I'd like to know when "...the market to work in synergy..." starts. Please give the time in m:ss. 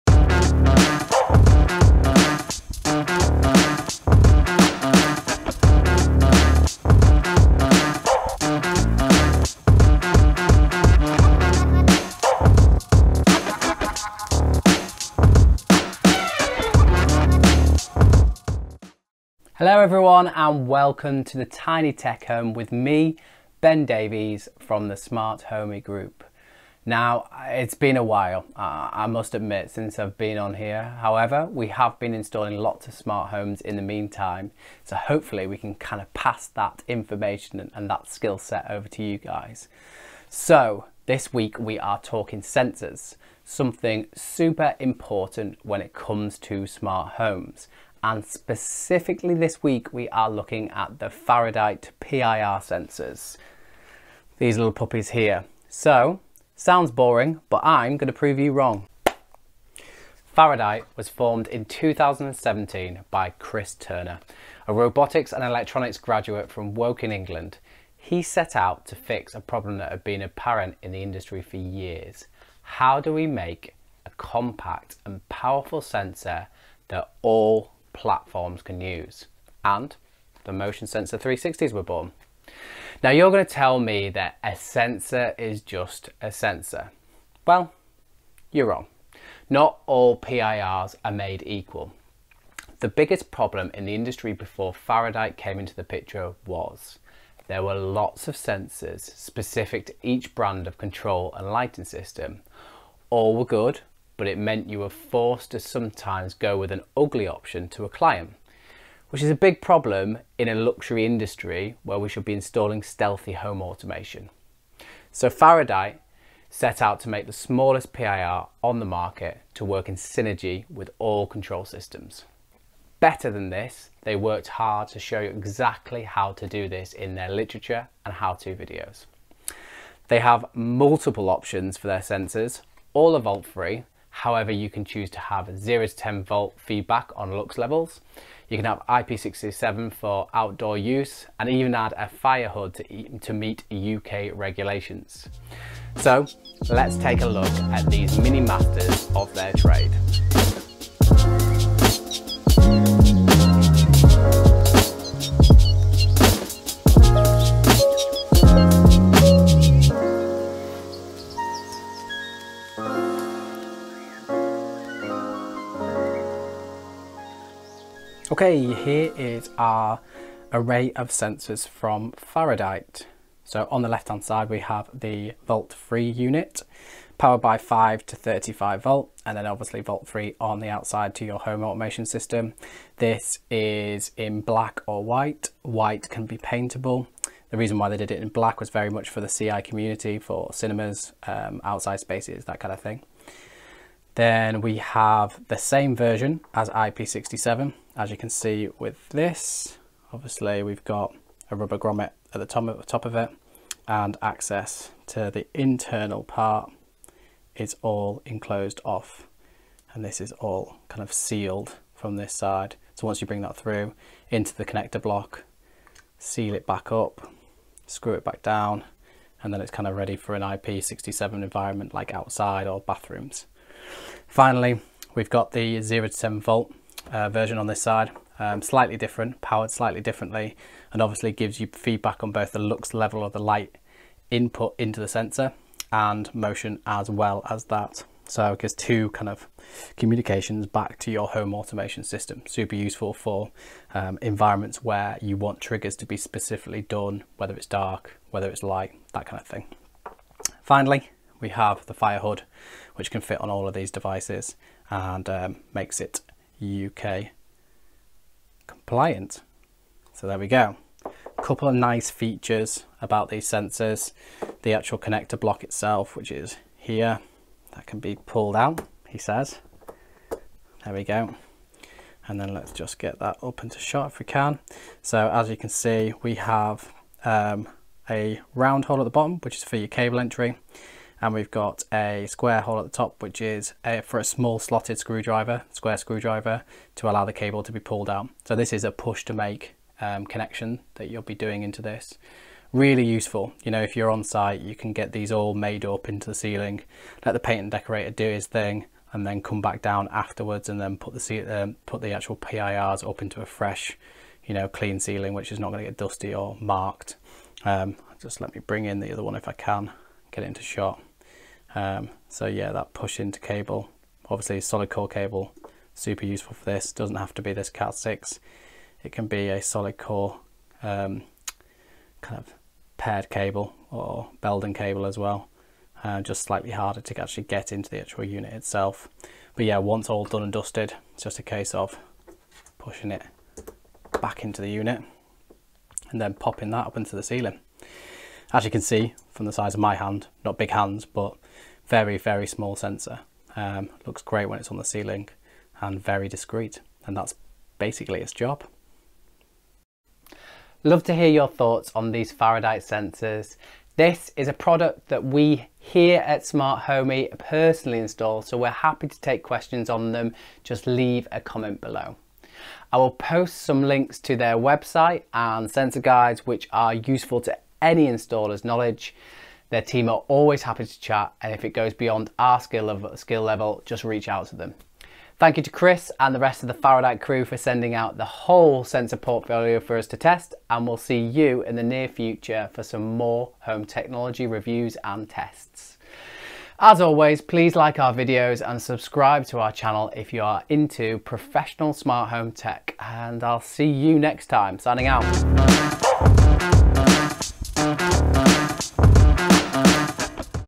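1:58.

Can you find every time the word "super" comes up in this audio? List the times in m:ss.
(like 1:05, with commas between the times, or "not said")
0:44, 4:02, 5:15.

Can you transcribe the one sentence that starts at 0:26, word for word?
Now, it's been a while, uh, I must admit, since I've been on here.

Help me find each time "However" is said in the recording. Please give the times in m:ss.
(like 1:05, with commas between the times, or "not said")
0:30, 2:14.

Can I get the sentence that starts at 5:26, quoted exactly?
Uh, just slightly harder to actually get into the actual unit itself.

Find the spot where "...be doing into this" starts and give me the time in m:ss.
4:51.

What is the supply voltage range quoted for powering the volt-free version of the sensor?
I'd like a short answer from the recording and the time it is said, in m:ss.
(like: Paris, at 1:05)
5 to 35 volt, at 2:57.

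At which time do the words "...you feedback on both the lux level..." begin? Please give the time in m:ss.
3:51.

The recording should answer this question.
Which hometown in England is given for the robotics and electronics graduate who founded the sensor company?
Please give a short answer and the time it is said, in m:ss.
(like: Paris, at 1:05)
Woking, at 1:06.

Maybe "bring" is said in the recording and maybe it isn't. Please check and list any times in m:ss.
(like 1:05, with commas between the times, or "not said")
3:33, 5:08.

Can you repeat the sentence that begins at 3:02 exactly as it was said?
This is in black or white.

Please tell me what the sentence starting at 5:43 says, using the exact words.
Um, looks great when it's on the ceiling and very discreet.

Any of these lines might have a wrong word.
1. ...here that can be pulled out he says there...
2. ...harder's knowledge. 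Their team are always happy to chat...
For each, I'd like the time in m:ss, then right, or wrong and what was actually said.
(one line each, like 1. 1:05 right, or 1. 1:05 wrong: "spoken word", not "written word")
1. 4:26 right
2. 6:08 wrong: "installer", not "harder".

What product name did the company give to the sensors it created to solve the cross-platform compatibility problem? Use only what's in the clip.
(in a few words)
Motion Sensor 360s.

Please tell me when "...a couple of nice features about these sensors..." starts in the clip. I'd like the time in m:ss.
4:21.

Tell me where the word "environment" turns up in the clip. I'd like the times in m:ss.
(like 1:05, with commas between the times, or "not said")
3:41, 4:04.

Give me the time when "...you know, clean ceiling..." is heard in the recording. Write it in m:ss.
5:04.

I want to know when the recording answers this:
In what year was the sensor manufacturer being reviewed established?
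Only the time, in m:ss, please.
1:01.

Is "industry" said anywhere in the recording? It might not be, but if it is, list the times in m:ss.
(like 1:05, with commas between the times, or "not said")
1:11, 1:33, 1:51.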